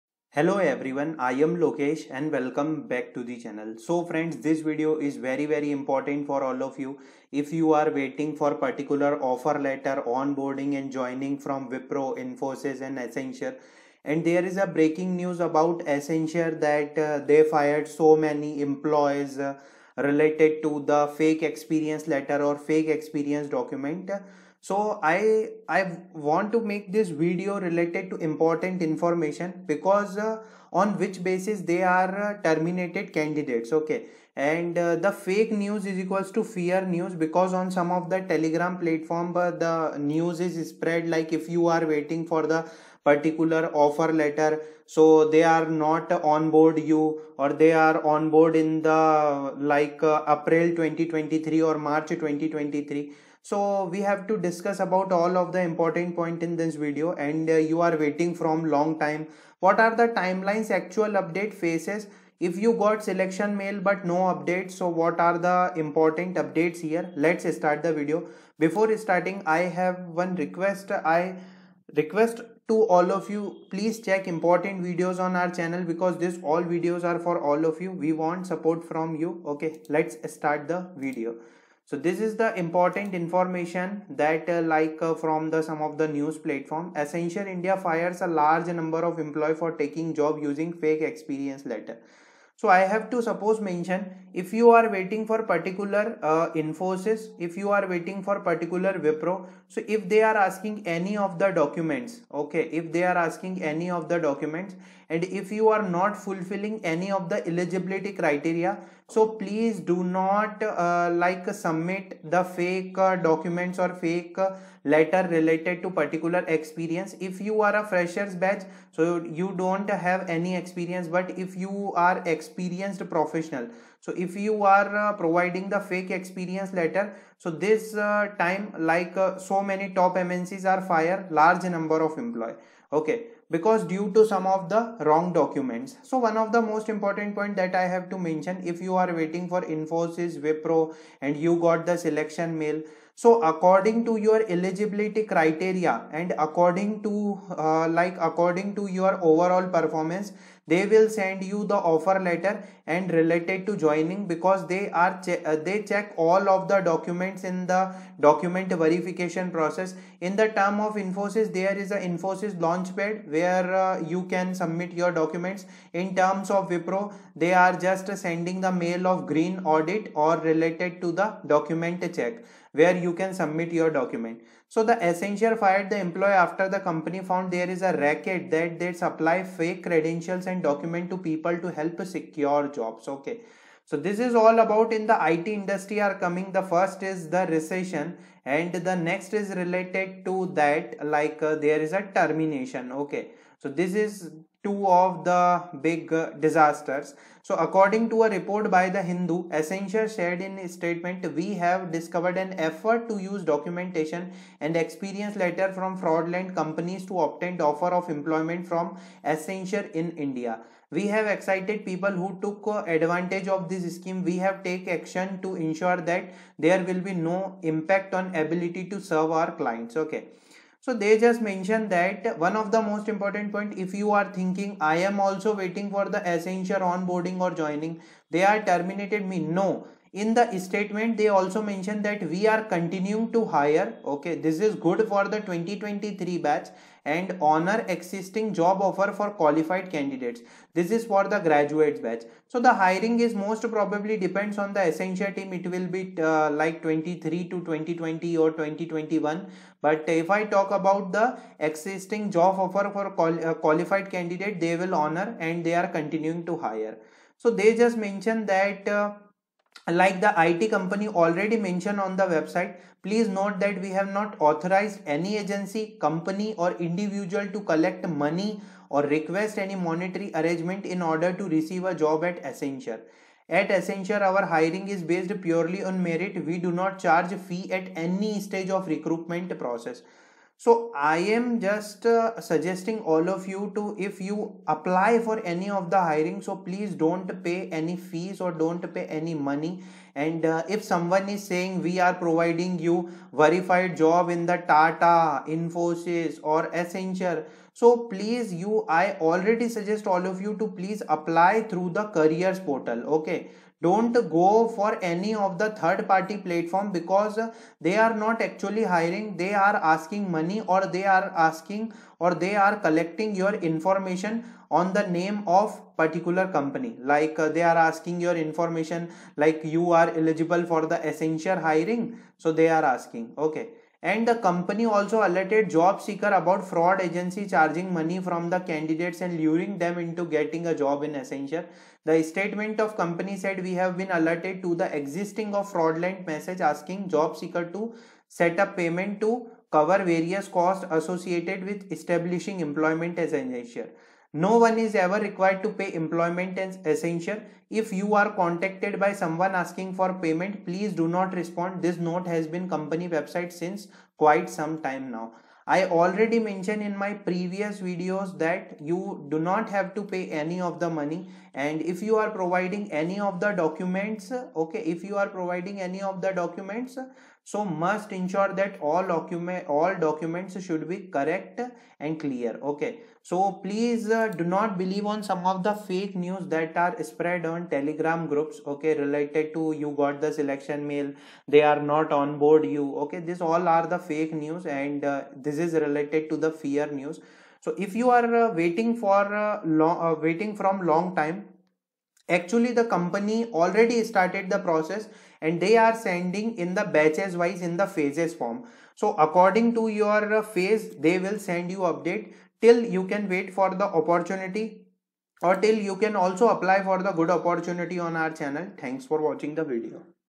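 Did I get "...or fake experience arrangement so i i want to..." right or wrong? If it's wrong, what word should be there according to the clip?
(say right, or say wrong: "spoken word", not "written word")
wrong: "document", not "arrangement".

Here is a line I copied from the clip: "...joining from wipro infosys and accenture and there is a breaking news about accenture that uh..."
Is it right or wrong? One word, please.
right.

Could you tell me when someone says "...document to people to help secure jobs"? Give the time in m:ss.
3:00.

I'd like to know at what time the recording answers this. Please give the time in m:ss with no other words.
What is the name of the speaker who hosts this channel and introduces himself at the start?
0:01.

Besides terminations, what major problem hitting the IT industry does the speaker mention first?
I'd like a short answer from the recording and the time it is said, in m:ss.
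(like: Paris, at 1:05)
recession, at 3:07.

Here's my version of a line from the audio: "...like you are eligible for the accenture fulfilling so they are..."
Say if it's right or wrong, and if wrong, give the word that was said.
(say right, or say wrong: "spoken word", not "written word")
wrong: "hiring", not "fulfilling".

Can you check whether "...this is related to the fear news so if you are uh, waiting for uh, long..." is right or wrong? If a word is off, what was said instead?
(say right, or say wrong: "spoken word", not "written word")
right.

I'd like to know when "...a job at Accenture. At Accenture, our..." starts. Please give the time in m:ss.
4:31.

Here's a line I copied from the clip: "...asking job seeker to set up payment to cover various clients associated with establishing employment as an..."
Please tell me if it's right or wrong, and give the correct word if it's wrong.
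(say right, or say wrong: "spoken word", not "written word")
wrong: "costs", not "clients".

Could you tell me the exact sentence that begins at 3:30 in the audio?
We have excited people who took uh, advantage of this scheme.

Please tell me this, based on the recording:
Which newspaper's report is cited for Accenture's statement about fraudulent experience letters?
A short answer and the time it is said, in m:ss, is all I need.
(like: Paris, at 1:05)
The Hindu, at 3:18.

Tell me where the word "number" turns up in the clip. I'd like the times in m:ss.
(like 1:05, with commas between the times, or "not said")
1:28, 2:11.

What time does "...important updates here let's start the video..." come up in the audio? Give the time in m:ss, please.
1:05.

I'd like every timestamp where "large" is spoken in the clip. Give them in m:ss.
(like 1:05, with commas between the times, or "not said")
1:28, 2:11.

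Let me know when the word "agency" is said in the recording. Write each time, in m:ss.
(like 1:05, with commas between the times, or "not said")
4:25, 5:27.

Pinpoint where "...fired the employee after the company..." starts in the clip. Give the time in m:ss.
2:55.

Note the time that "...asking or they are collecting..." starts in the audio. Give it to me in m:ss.
5:11.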